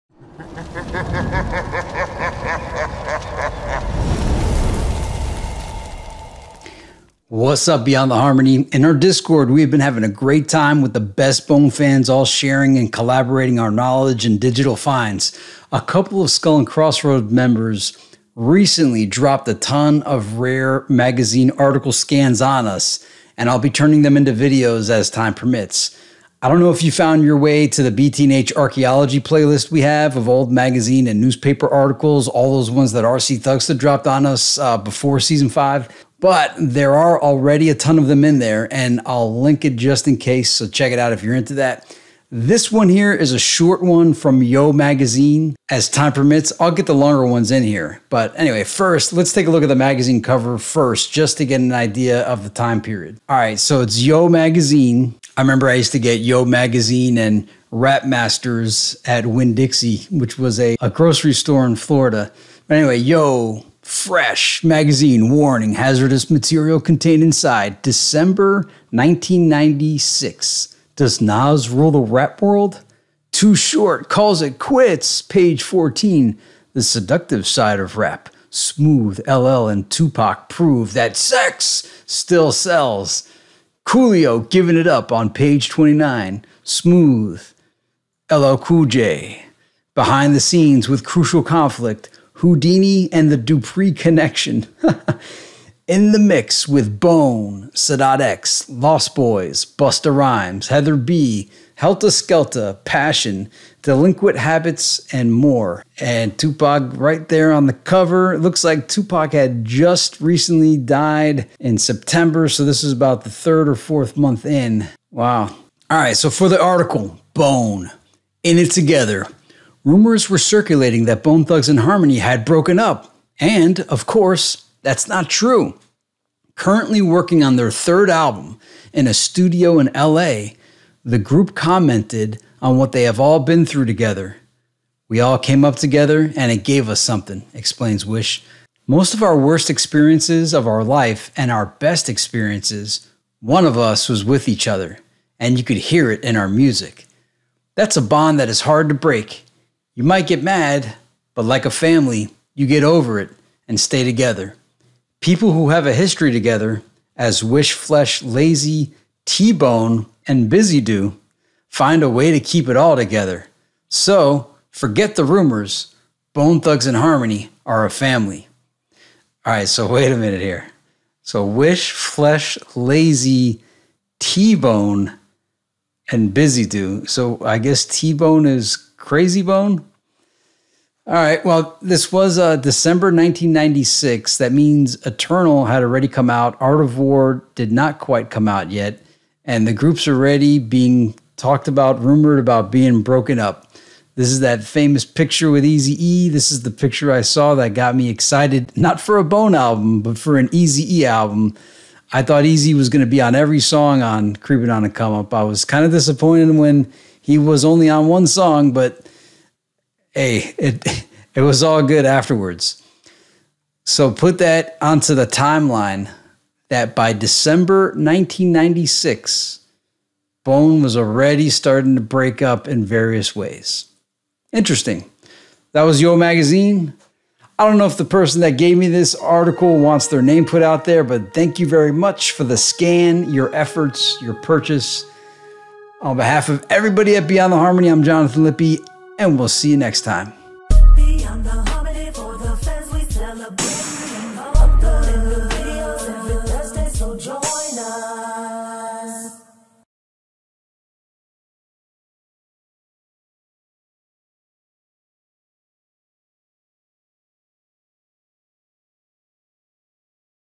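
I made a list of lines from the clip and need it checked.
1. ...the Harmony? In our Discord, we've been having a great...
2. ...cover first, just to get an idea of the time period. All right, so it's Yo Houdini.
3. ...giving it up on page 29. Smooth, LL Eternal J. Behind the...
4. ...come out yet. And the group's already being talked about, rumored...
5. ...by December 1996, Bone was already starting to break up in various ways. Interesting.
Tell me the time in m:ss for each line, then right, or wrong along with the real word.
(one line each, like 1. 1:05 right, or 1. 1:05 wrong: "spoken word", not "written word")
1. 0:08 right
2. 0:50 wrong: "Magazine", not "Houdini"
3. 1:24 wrong: "Cool", not "Eternal"
4. 3:08 right
5. 3:36 right.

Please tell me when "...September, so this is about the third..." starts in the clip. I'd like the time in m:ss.
1:51.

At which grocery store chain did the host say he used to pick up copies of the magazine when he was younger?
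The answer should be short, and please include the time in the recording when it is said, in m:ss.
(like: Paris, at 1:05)
Winn Dixie, at 0:59.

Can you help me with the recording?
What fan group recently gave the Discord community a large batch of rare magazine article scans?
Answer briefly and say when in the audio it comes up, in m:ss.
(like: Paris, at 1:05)
Skull and Crossroad, at 0:16.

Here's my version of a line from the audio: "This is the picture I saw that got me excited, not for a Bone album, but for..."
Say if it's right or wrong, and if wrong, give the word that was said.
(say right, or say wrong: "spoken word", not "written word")
right.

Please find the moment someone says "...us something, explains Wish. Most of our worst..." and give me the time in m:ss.
2:16.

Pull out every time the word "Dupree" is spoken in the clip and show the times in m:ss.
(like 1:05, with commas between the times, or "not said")
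1:33.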